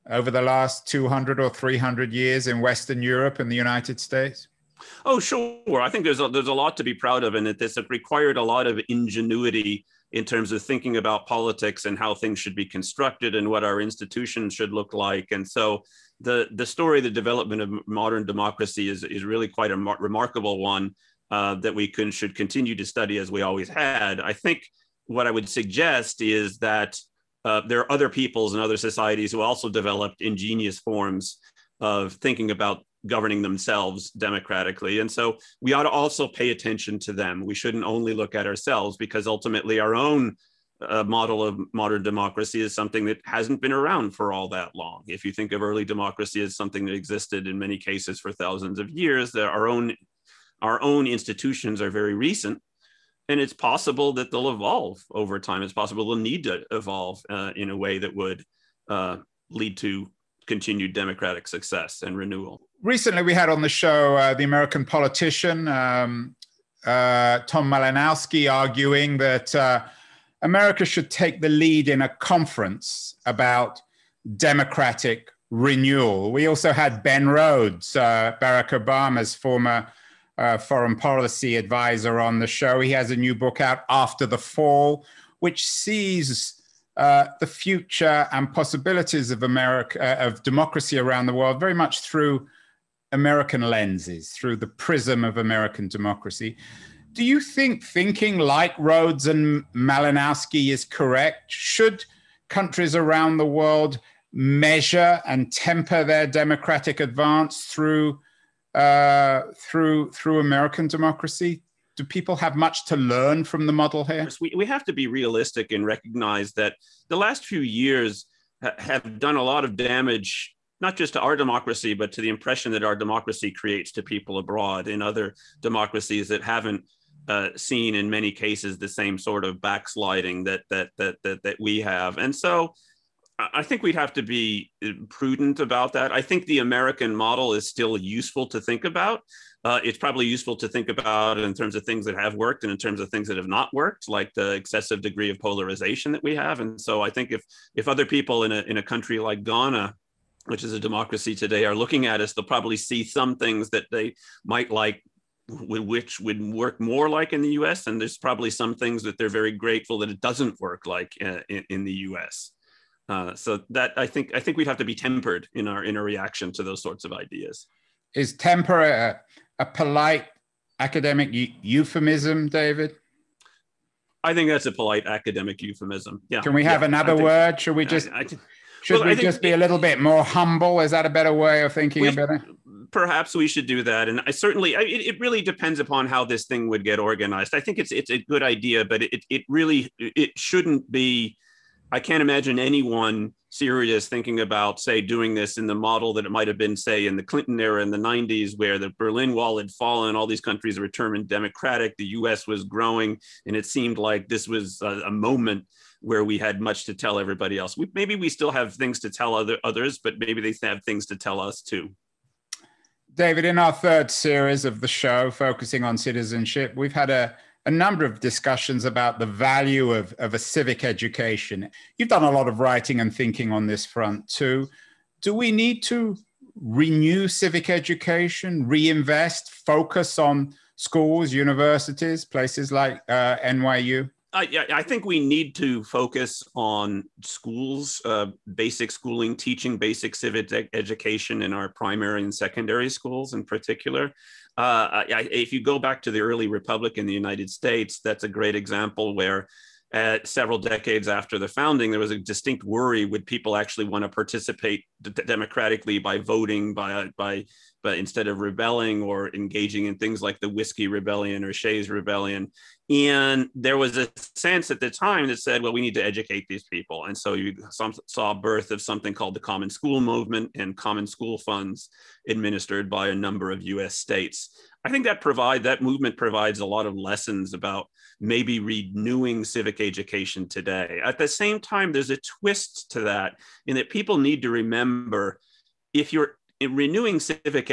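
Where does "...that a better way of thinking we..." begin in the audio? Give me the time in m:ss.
3:00.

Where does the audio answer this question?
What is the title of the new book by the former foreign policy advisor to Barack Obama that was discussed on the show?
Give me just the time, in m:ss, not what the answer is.
1:23.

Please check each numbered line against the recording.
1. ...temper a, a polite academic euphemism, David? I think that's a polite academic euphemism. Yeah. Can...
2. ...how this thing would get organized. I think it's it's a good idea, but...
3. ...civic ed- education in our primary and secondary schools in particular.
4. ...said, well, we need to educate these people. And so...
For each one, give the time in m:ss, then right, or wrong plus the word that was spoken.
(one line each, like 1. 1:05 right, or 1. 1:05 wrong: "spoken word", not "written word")
1. 2:48 right
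2. 3:06 right
3. 4:00 right
4. 4:25 right.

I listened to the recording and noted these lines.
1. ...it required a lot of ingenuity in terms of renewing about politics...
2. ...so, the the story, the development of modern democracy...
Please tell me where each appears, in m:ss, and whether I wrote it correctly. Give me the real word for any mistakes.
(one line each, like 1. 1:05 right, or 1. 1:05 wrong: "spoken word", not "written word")
1. 0:07 wrong: "thinking", not "renewing"
2. 0:15 right.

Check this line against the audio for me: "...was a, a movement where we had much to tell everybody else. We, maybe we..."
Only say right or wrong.
wrong.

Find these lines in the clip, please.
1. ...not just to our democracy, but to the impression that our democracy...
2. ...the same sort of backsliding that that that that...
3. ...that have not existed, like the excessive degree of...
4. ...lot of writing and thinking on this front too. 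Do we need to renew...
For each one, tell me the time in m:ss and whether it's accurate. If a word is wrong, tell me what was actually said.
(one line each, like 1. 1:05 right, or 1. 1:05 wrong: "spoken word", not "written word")
1. 2:00 right
2. 2:08 right
3. 2:23 wrong: "worked", not "existed"
4. 3:42 right.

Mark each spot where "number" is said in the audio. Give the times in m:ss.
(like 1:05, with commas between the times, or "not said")
3:37, 4:33.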